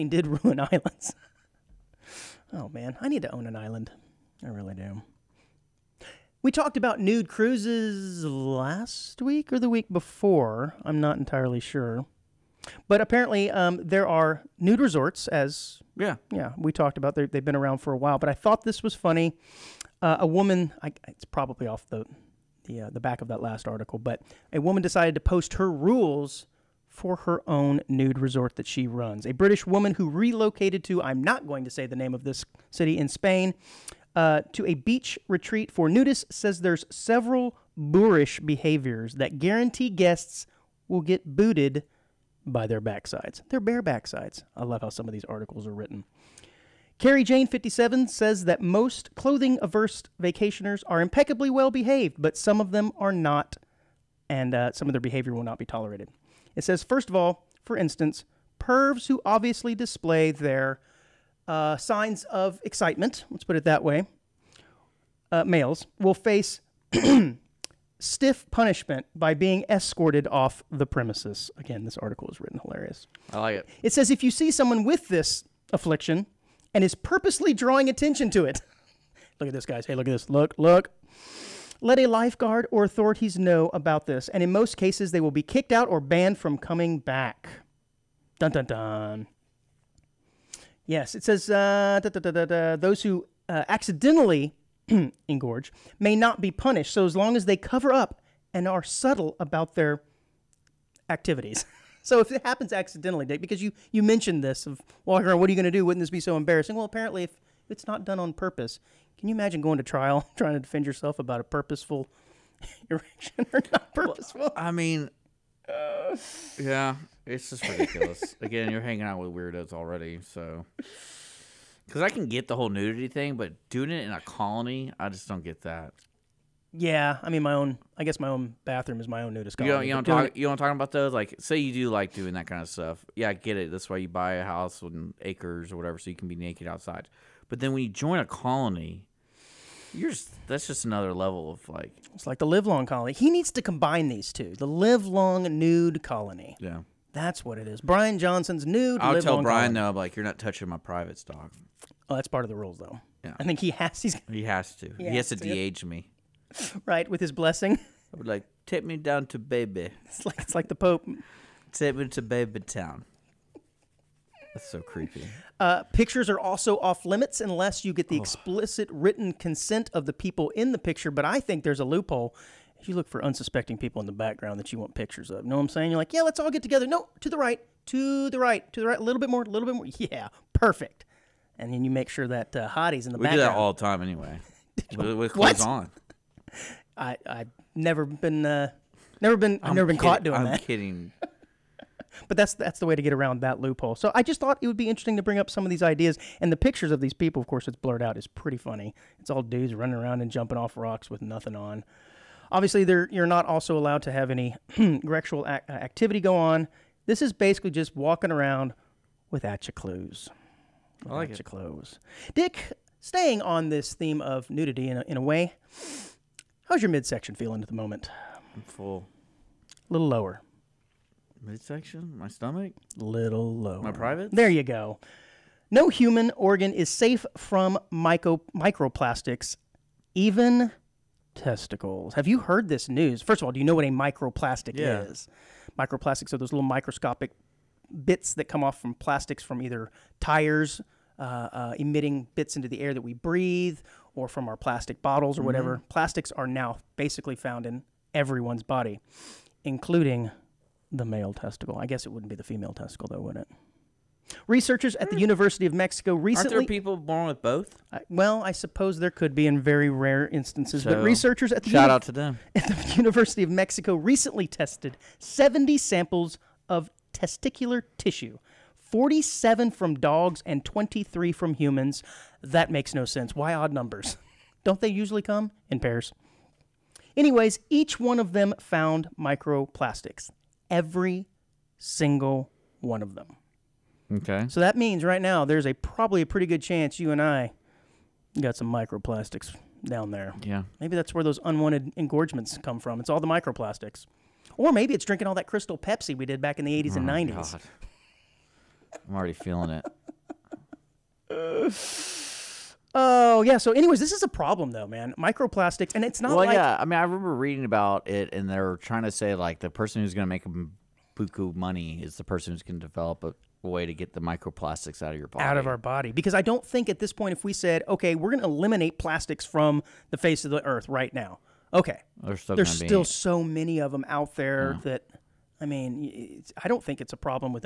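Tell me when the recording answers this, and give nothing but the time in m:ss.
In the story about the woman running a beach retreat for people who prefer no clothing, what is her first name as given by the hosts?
0:46.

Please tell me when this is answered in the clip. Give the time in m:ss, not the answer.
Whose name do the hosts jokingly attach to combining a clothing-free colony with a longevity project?
2:27.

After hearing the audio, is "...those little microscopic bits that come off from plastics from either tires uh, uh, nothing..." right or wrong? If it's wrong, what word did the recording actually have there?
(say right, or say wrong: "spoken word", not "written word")
wrong: "emitting", not "nothing".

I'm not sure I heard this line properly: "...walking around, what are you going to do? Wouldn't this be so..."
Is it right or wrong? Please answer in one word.
right.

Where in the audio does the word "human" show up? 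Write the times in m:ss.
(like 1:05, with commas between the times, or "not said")
3:45, 4:31.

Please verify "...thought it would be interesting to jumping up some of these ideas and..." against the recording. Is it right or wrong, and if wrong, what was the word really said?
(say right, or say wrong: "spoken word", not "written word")
wrong: "bring", not "jumping".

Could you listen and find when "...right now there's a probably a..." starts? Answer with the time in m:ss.
4:45.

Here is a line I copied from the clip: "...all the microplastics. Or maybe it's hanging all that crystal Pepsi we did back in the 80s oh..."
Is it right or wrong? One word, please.
wrong.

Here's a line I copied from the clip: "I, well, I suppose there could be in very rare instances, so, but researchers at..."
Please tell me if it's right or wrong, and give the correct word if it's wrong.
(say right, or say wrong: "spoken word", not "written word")
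right.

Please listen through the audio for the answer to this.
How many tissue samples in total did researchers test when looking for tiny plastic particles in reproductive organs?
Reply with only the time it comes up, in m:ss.
4:25.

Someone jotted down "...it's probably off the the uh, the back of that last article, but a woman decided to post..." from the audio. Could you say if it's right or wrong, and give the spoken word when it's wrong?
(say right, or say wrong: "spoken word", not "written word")
right.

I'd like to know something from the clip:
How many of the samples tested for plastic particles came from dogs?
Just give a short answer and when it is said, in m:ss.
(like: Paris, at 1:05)
47, at 4:28.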